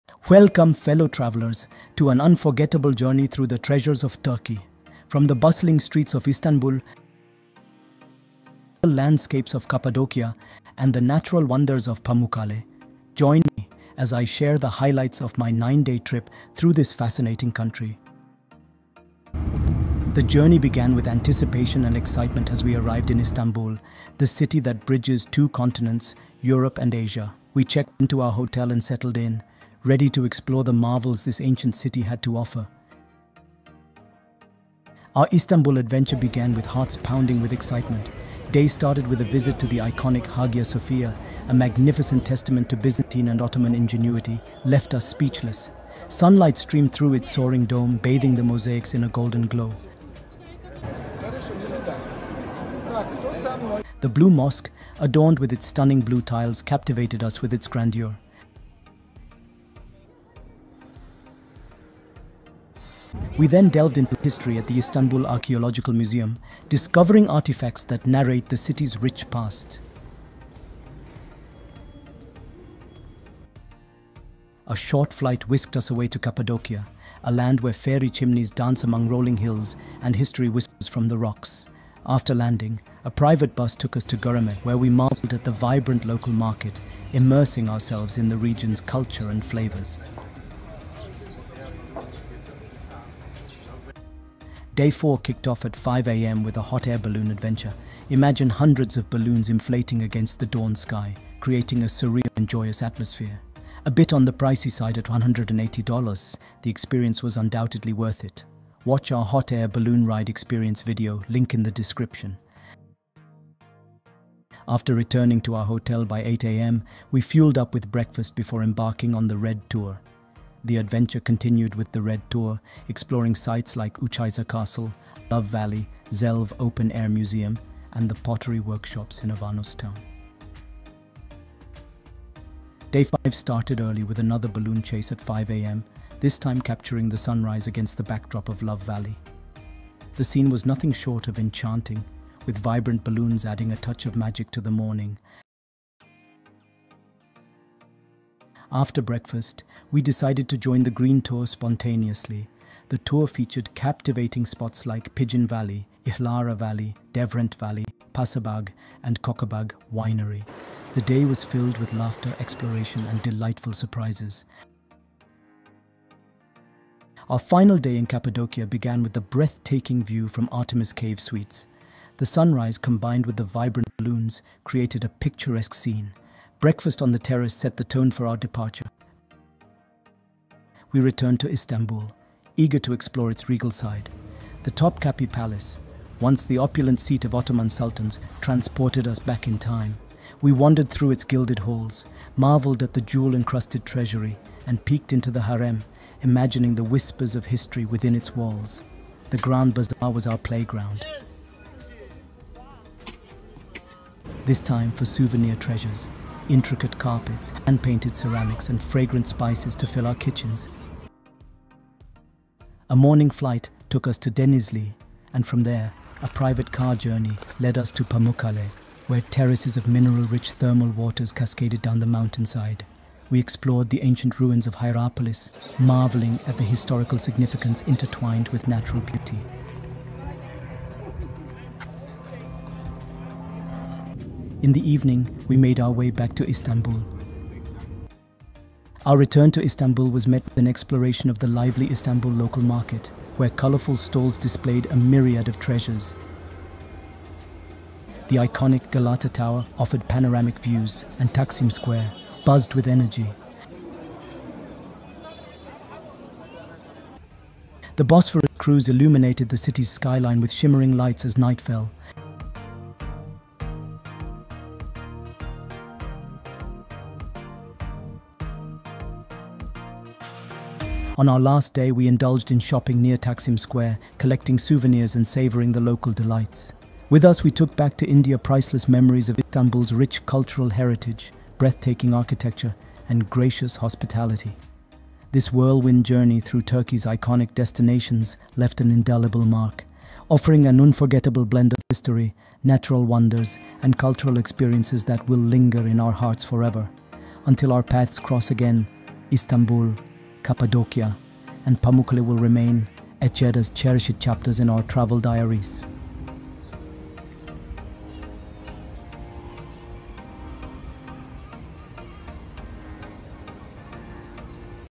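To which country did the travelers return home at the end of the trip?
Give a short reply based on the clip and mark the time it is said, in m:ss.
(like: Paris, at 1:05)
India, at 4:38.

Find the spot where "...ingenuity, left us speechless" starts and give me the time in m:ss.
0:43.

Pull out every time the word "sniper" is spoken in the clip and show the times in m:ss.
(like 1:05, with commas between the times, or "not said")
not said.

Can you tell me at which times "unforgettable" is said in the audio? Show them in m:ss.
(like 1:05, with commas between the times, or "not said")
0:02, 4:50.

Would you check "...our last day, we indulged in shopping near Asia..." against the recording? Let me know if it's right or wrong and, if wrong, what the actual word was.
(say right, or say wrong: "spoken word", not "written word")
wrong: "Taksim", not "Asia".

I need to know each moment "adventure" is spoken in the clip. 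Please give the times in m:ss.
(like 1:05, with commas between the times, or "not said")
0:35, 1:37, 2:00.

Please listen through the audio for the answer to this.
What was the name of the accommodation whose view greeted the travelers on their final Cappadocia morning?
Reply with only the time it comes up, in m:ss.
2:50.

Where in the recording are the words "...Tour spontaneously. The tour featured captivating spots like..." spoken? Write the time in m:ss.
2:31.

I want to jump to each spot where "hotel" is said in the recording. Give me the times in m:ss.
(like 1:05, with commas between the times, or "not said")
0:28, 1:55.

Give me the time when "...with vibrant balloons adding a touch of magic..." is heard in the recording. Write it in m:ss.
2:22.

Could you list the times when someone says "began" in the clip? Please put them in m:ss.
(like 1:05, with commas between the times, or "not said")
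0:20, 0:36, 2:48.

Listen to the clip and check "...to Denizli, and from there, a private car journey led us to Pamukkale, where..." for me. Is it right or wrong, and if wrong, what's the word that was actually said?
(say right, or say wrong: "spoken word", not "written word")
right.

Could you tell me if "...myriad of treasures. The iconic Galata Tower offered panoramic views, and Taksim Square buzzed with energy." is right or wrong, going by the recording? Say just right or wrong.
right.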